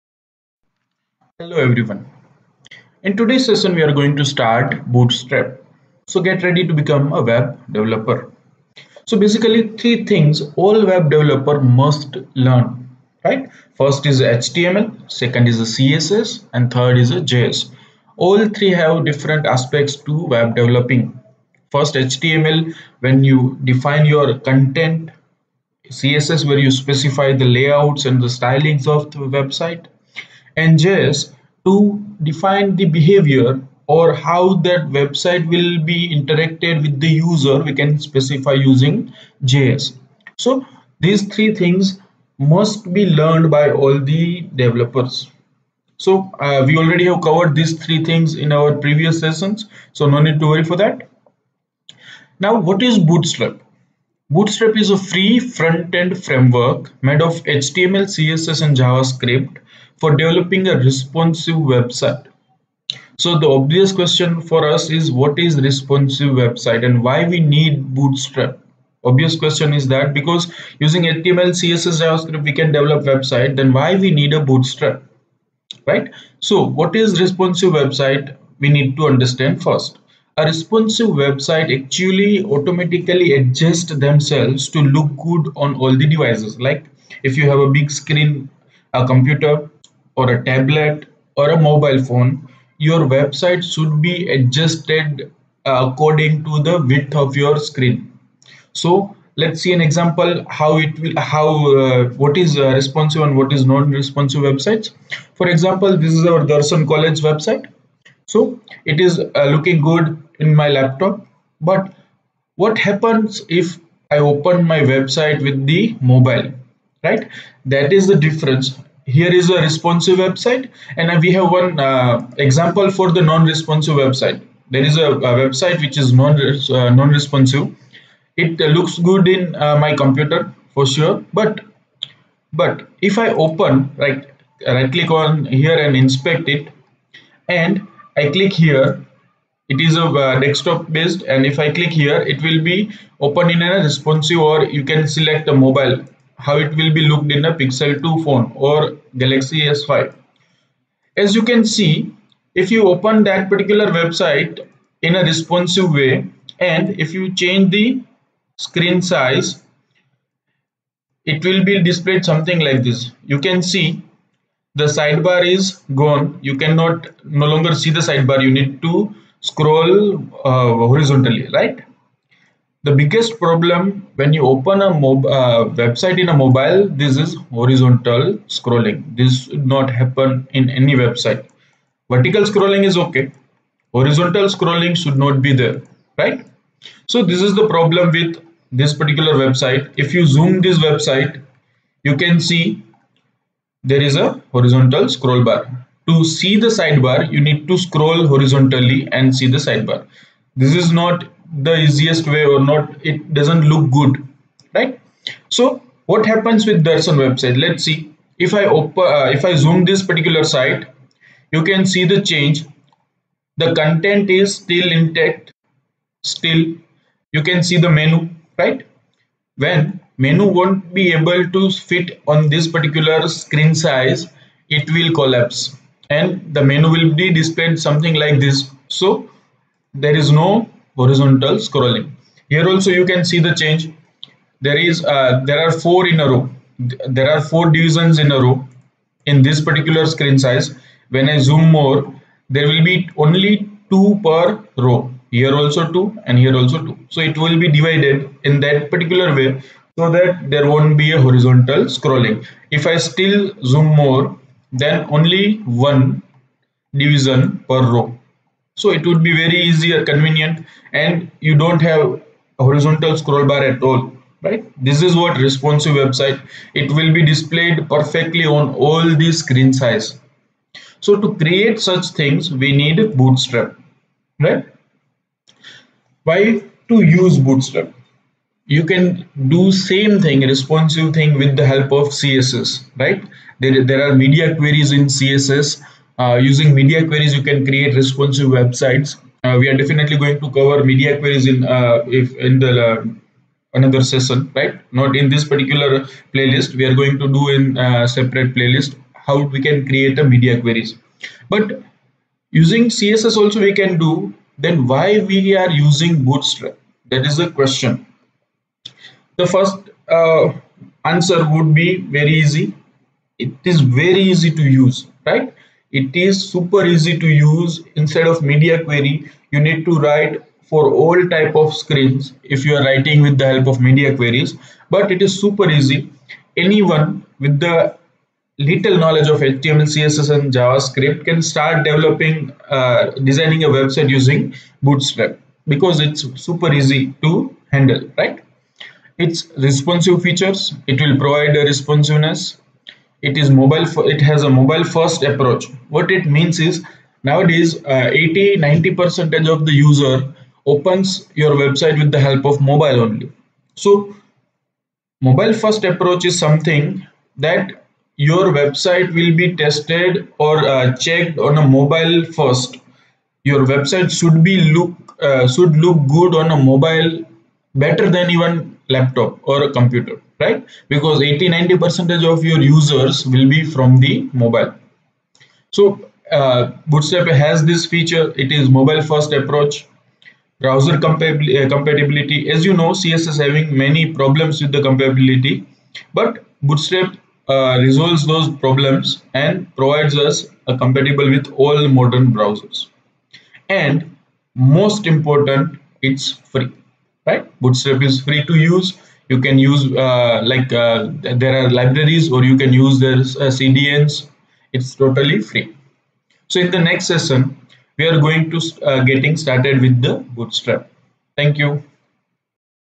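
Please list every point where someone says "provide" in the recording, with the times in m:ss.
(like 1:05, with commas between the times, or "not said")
5:41, 6:29.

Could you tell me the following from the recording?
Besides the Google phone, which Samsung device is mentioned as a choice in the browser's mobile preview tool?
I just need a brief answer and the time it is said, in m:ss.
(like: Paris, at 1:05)
Galaxy S5, at 2:29.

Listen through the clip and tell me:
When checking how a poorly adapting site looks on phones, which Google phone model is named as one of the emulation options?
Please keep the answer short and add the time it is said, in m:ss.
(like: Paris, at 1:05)
Pixel 2, at 2:27.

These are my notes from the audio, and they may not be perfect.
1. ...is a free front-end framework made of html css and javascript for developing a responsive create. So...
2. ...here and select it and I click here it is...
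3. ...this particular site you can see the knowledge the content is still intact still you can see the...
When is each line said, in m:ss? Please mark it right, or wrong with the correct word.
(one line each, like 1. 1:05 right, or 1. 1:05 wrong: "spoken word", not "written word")
1. 0:54 wrong: "website", not "create"
2. 2:15 wrong: "inspect", not "select"
3. 3:29 wrong: "change", not "knowledge".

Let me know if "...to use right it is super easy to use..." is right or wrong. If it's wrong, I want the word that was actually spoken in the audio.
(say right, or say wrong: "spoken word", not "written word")
right.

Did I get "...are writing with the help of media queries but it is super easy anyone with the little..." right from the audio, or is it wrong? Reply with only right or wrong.
right.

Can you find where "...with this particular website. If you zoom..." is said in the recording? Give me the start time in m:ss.
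3:08.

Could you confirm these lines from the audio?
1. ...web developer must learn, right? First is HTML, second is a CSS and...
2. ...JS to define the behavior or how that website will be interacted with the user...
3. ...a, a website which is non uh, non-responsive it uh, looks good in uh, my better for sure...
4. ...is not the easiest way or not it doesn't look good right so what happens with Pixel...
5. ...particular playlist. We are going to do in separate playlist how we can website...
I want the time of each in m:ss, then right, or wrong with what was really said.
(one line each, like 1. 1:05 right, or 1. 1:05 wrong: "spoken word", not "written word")
1. 0:10 right
2. 0:30 right
3. 2:04 wrong: "computer", not "better"
4. 3:20 wrong: "Darshan", not "Pixel"
5. 4:55 wrong: "create", not "website".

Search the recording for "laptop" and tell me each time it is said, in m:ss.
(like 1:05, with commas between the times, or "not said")
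1:50, 6:08.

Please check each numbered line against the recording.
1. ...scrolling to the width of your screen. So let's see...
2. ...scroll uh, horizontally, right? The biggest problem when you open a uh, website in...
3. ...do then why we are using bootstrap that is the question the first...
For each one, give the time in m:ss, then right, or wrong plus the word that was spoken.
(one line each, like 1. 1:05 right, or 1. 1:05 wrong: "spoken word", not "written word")
1. 1:35 wrong: "according", not "scrolling"
2. 2:49 right
3. 5:03 right.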